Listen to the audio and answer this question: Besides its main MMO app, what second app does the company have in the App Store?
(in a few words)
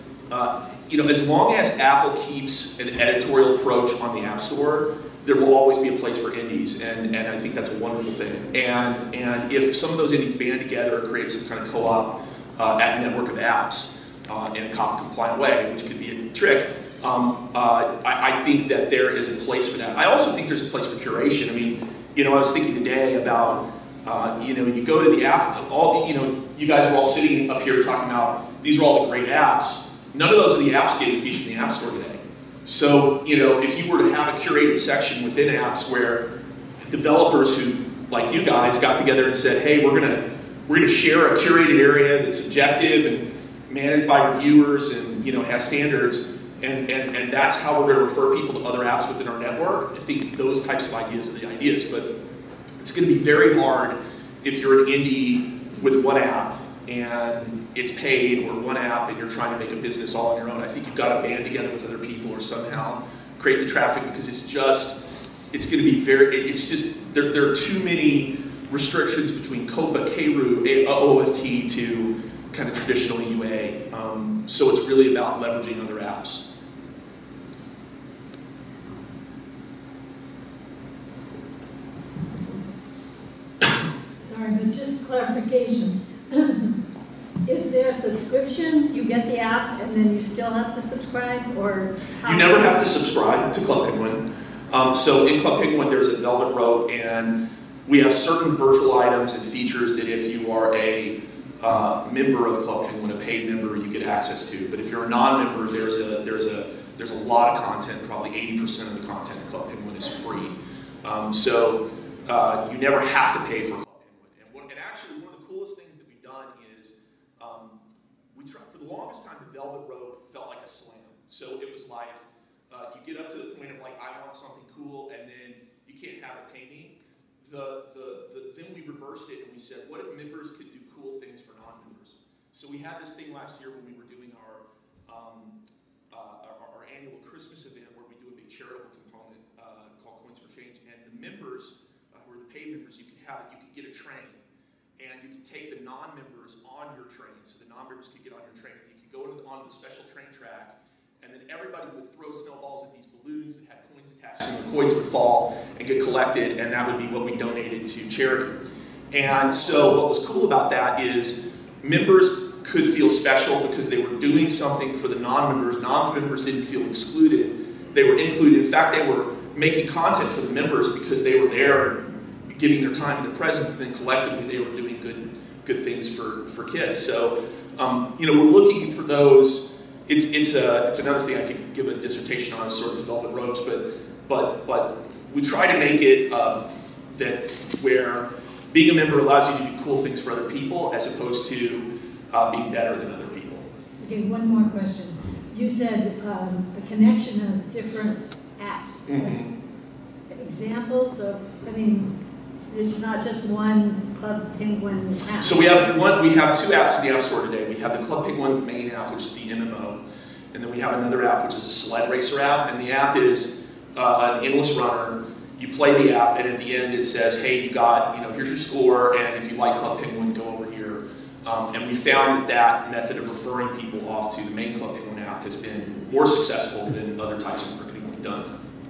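A sled racer.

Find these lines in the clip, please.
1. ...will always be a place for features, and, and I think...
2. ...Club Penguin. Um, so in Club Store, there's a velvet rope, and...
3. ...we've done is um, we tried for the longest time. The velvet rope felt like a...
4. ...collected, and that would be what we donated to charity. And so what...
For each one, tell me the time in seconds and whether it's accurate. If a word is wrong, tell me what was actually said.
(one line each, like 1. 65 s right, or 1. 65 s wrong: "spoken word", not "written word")
1. 5 s wrong: "indies", not "features"
2. 93 s wrong: "Penguin", not "Store"
3. 116 s right
4. 156 s right.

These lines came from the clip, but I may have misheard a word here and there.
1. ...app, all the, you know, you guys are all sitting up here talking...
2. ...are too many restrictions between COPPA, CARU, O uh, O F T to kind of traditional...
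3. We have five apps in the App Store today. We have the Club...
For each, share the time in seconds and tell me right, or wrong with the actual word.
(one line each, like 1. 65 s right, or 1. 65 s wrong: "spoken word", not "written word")
1. 25 s right
2. 67 s right
3. 206 s wrong: "two", not "five".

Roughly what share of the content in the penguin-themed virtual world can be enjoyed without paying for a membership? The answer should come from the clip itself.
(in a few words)
80%.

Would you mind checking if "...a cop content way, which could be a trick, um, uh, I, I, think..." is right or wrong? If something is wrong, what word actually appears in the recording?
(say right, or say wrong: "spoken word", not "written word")
wrong: "compliant", not "content".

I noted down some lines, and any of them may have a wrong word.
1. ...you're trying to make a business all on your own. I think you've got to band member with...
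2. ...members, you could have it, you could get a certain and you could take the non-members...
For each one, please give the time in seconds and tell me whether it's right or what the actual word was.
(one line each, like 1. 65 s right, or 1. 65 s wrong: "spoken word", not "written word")
1. 59 s wrong: "together", not "member"
2. 142 s wrong: "train", not "certain".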